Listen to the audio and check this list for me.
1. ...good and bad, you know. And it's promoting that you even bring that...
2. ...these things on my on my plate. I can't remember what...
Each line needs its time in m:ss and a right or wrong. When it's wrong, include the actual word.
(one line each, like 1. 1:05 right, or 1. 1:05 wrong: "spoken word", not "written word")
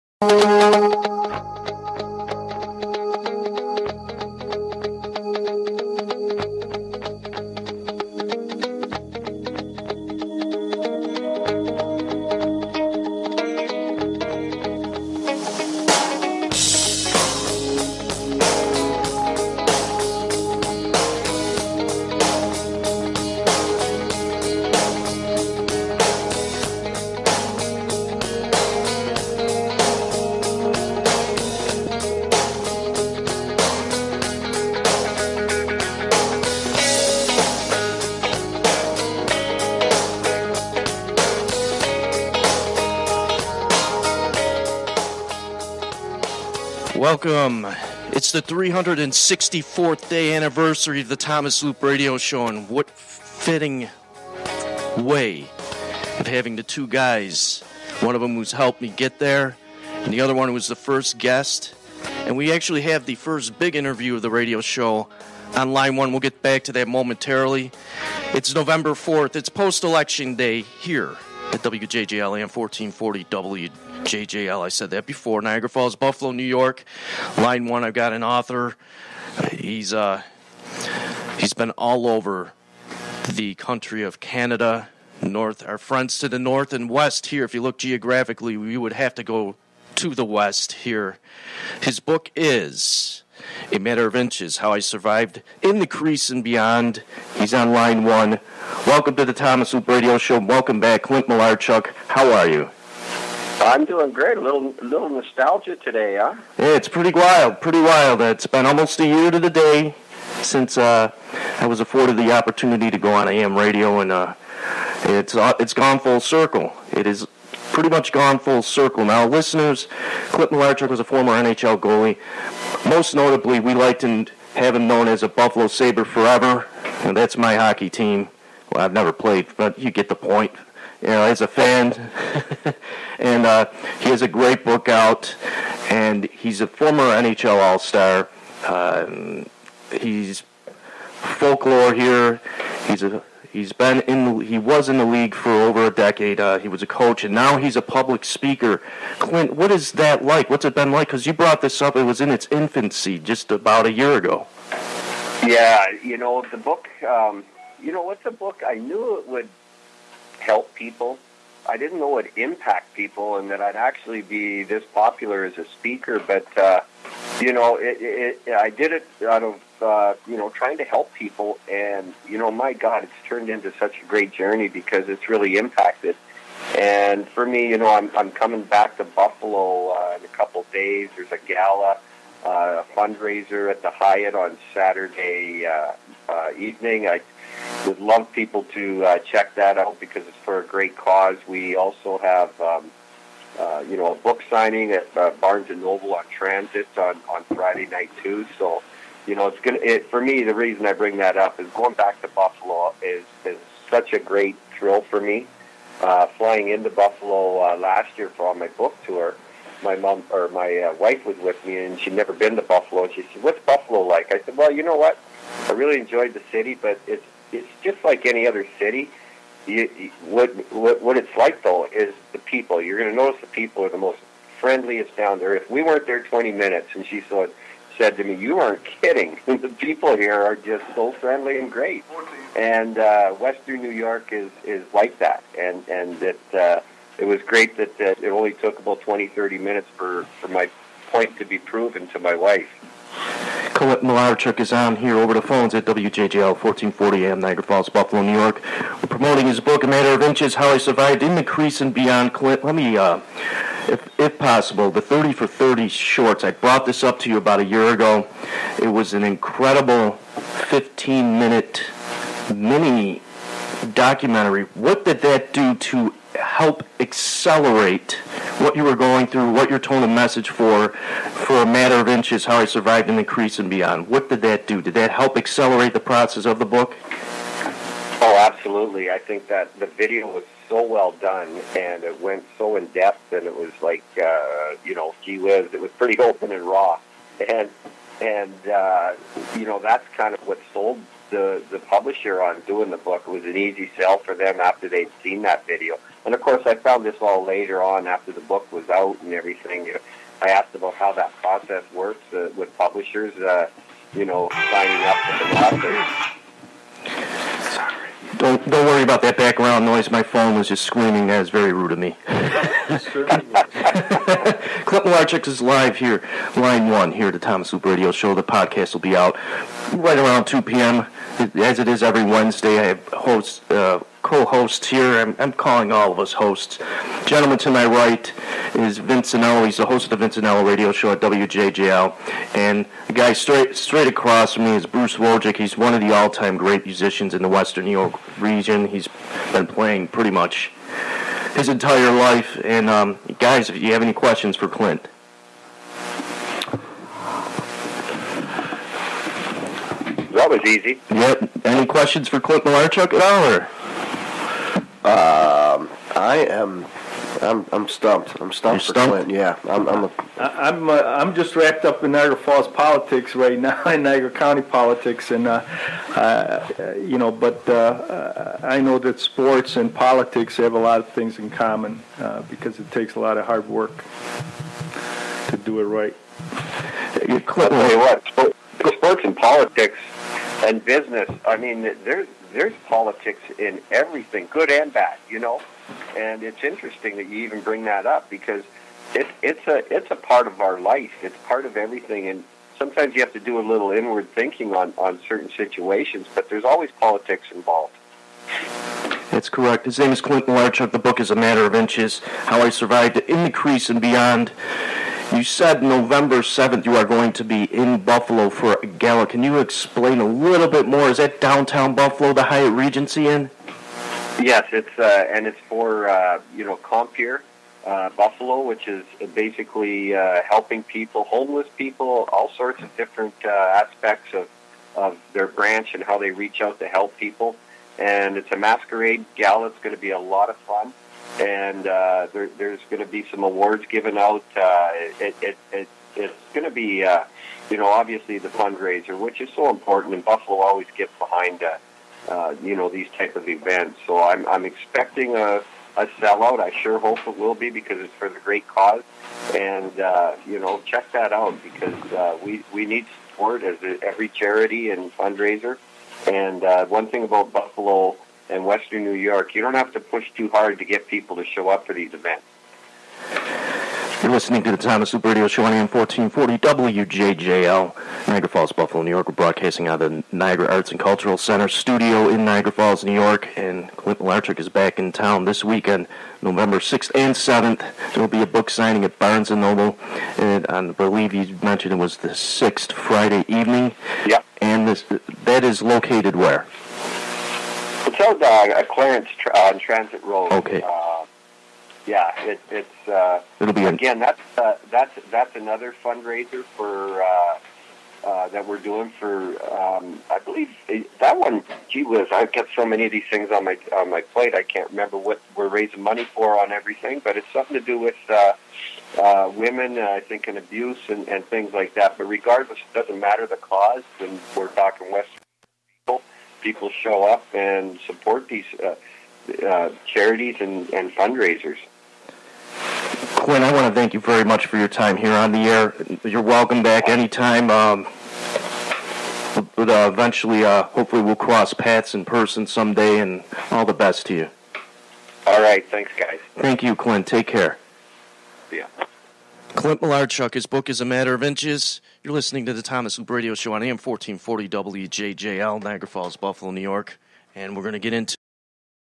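1. 6:24 wrong: "interesting", not "promoting"
2. 8:23 right.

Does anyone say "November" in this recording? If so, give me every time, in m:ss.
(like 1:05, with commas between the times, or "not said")
1:08, 6:45, 7:56.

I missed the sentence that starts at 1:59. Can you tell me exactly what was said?
Now, listeners, Clint Malarchuk was a former NHL goalie.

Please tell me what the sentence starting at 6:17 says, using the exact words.
Clint, tell you what, sports and politics and business.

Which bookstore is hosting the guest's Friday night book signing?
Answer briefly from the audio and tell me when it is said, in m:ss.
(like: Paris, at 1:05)
Barnes and Noble, at 3:15.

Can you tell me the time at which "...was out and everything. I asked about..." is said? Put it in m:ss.
4:58.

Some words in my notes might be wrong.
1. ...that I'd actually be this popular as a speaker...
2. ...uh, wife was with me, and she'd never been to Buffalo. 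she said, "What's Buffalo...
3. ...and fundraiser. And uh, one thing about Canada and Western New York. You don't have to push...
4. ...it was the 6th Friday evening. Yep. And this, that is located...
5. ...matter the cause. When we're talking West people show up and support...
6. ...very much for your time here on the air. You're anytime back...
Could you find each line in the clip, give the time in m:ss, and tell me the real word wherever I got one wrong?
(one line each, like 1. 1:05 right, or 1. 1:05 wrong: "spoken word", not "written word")
1. 2:43 right
2. 3:30 right
3. 7:34 wrong: "Buffalo", not "Canada"
4. 8:01 right
5. 8:33 right
6. 8:44 wrong: "welcome", not "anytime".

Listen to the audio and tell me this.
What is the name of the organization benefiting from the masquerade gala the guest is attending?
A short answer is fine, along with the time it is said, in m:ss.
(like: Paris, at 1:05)
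Compeer, at 6:56.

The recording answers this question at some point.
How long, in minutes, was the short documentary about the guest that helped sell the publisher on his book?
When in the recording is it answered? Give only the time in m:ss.
4:20.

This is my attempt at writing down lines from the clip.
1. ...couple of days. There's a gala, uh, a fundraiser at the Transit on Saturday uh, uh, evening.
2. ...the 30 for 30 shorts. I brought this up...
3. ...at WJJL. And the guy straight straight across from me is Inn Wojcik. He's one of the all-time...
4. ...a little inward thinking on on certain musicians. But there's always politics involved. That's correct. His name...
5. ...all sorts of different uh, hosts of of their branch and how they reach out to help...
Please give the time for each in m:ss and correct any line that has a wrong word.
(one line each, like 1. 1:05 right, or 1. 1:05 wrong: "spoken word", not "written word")
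1. 3:00 wrong: "Hyatt", not "Transit"
2. 4:14 right
3. 5:31 wrong: "Bruce", not "Inn"
4. 6:33 wrong: "situations", not "musicians"
5. 7:02 wrong: "aspects", not "hosts".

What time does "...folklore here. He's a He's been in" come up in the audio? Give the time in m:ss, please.
2:21.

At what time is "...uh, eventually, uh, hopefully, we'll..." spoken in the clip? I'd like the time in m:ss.
8:49.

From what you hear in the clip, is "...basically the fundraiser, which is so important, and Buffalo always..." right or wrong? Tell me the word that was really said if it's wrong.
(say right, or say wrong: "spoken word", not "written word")
wrong: "obviously", not "basically".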